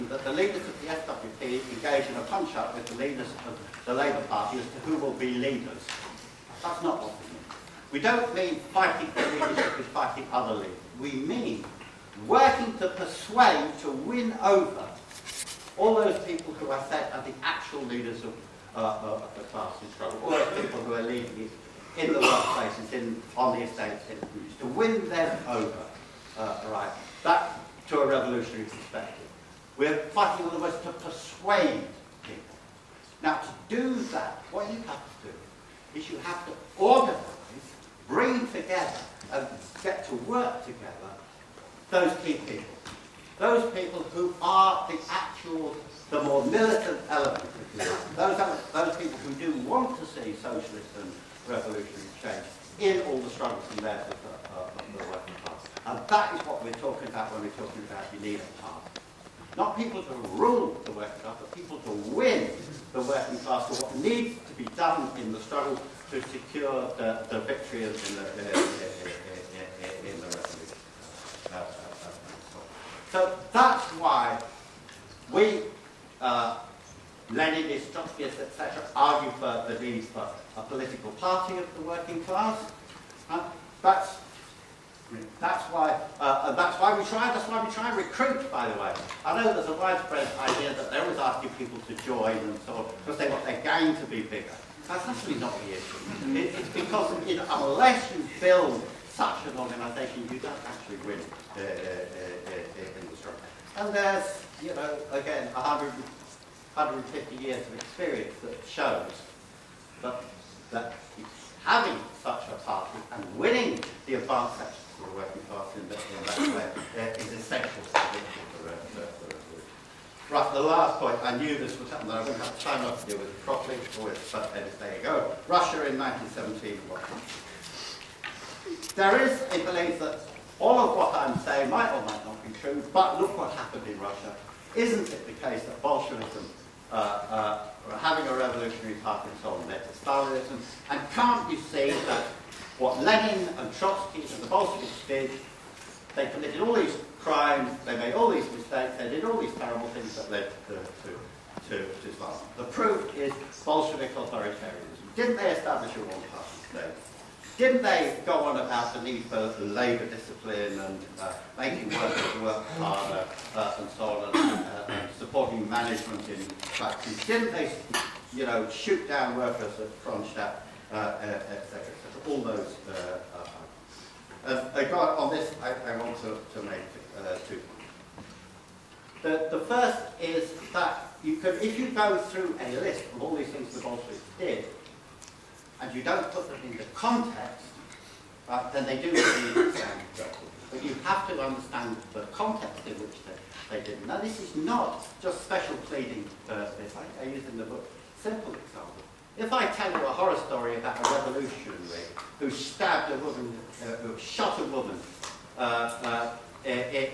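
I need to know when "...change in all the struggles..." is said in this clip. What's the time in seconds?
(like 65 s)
52 s.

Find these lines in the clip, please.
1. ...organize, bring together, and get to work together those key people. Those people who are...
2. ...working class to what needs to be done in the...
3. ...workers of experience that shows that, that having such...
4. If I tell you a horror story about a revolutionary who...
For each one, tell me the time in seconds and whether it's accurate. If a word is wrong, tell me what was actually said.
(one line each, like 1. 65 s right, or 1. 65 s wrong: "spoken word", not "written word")
1. 36 s right
2. 63 s right
3. 107 s wrong: "years", not "workers"
4. 199 s right.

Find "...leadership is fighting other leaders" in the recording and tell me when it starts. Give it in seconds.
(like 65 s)
9 s.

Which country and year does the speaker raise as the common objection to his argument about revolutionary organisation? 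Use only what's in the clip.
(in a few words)
Russia in 1917.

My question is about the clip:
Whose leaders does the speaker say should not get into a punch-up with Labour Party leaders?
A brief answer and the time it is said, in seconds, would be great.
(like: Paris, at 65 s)
SWP, at 0 s.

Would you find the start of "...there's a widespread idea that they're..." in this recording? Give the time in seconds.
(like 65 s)
89 s.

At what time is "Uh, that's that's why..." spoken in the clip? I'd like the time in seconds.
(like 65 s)
83 s.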